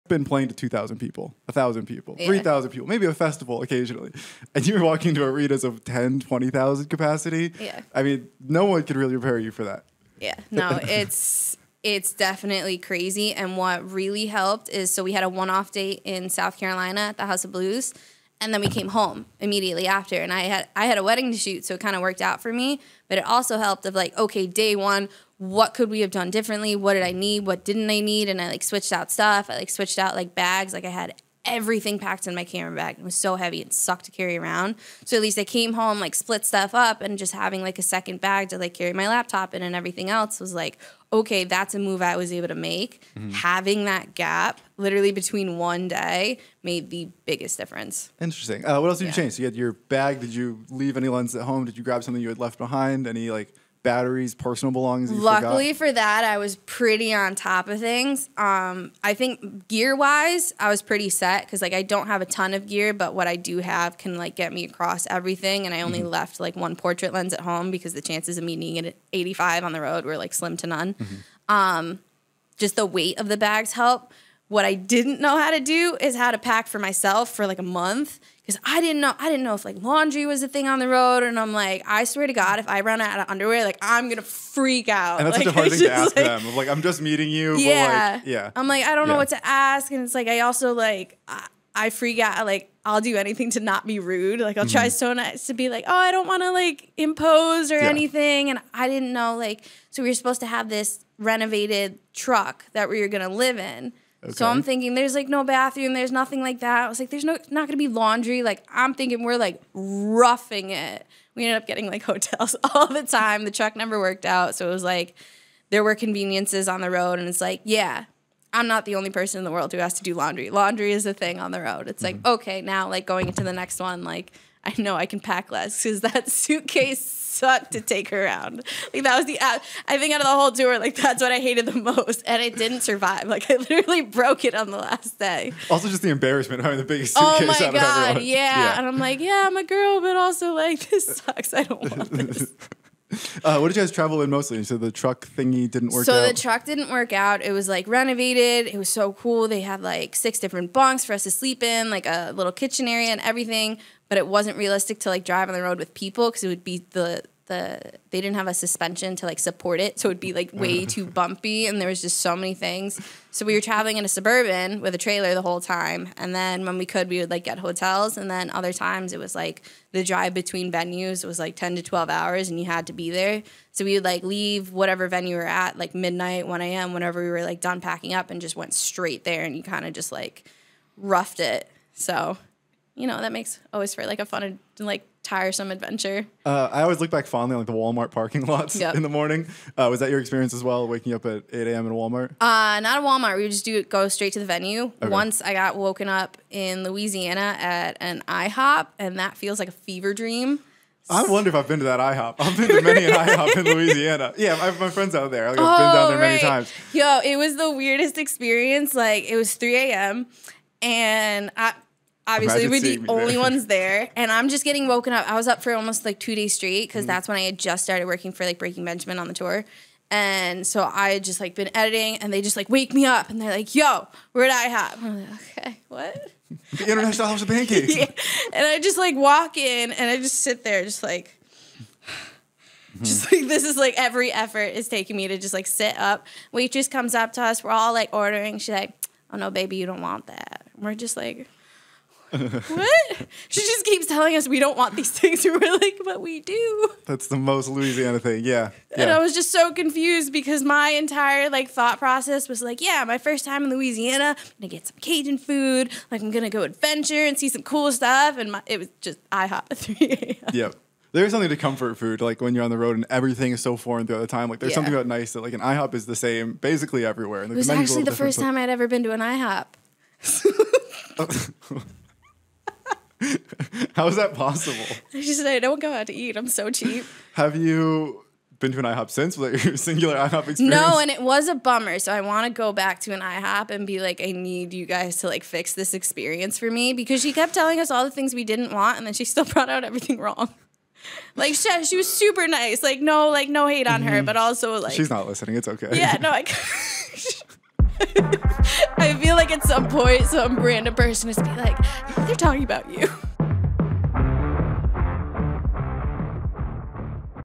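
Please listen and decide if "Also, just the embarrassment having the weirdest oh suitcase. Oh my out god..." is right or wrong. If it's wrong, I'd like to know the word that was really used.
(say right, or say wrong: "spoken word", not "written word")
wrong: "biggest", not "weirdest".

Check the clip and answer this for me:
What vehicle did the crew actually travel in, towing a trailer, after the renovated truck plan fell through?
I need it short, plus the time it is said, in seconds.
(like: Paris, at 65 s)
Suburban, at 164 s.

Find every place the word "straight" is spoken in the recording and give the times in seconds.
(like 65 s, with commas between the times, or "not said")
178 s, 194 s, 216 s.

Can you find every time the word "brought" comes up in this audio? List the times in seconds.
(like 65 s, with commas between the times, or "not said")
289 s.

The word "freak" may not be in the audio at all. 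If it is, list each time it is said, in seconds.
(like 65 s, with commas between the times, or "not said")
84 s, 91 s.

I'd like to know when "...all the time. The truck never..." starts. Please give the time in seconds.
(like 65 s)
112 s.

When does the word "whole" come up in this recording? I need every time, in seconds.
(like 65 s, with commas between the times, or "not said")
130 s, 165 s.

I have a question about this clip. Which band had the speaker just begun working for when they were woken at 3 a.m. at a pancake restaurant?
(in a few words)
Breaking Benjamin.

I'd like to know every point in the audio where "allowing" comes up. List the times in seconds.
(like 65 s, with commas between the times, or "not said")
not said.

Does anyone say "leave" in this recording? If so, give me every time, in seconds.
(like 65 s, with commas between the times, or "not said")
50 s, 174 s.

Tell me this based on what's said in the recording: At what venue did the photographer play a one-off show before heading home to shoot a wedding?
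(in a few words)
House of Blues.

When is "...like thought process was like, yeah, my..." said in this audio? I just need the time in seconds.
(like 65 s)
251 s.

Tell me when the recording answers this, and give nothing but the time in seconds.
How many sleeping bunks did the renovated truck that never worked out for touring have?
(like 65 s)
150 s.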